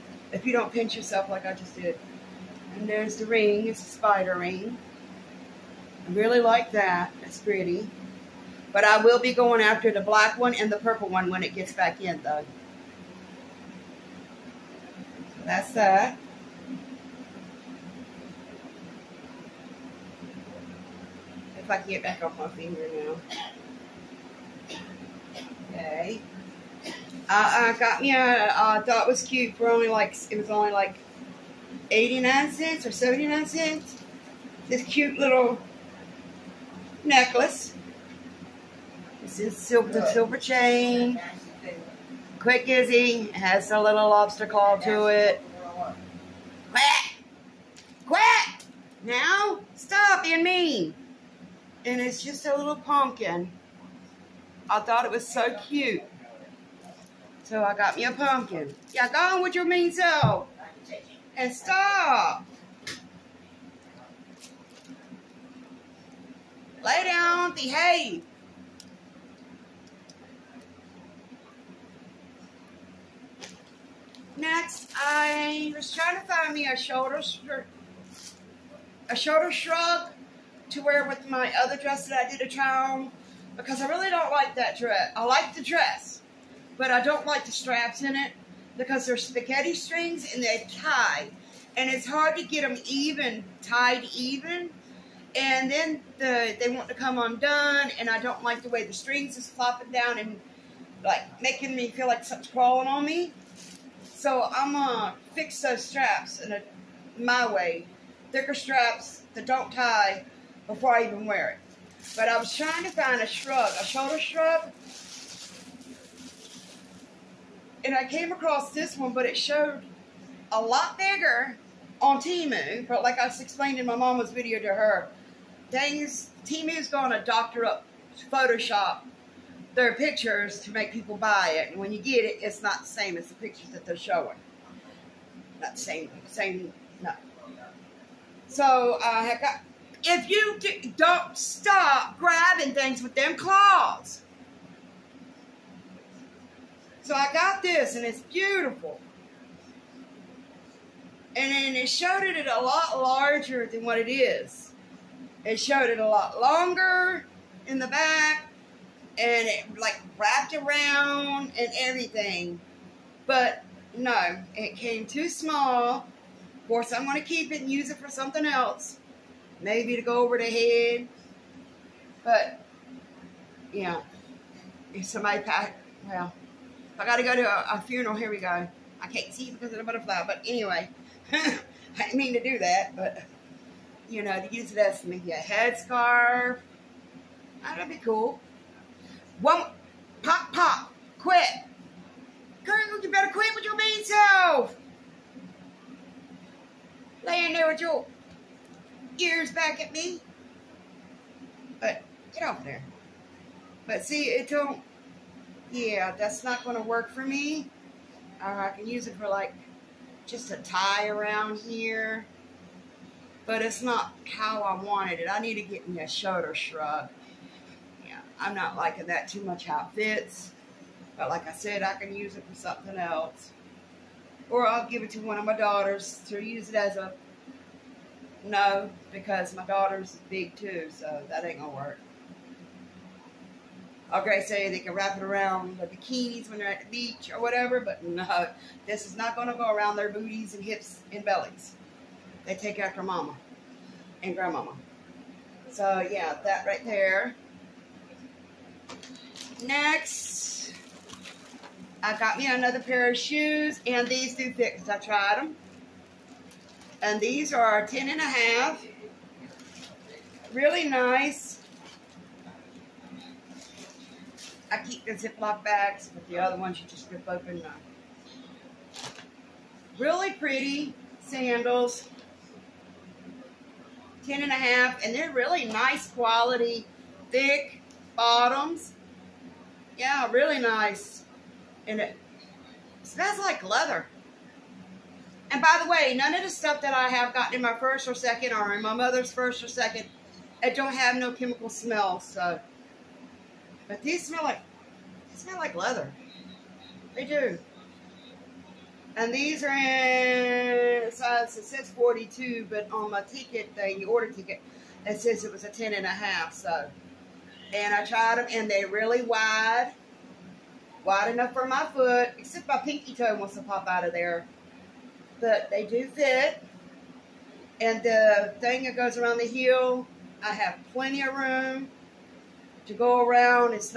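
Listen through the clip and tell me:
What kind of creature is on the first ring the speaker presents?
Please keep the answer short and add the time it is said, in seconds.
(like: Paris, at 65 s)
Spider, at 3 s.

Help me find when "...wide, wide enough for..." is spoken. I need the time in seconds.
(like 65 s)
309 s.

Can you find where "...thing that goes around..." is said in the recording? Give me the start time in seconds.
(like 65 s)
318 s.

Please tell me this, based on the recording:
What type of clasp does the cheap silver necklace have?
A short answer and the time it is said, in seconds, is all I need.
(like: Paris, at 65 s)
Lobster claw, at 44 s.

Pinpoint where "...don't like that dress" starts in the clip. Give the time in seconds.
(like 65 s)
84 s.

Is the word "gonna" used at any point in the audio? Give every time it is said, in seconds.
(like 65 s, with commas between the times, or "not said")
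104 s, 126 s, 231 s.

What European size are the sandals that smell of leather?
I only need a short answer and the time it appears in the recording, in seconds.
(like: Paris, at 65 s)
42, at 301 s.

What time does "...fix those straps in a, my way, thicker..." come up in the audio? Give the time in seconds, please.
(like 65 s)
105 s.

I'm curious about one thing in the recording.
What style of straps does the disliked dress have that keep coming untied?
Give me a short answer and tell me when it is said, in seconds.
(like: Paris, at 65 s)
Spaghetti strings, at 89 s.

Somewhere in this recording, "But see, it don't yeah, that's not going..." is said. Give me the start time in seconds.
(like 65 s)
203 s.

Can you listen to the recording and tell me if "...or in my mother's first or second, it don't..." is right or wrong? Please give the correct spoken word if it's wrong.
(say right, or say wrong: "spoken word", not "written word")
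right.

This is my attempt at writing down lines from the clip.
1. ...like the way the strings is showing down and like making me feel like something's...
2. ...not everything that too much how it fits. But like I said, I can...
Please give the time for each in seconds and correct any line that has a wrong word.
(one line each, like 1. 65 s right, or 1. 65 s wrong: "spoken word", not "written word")
1. 98 s wrong: "flopping", not "showing"
2. 218 s wrong: "liking", not "everything".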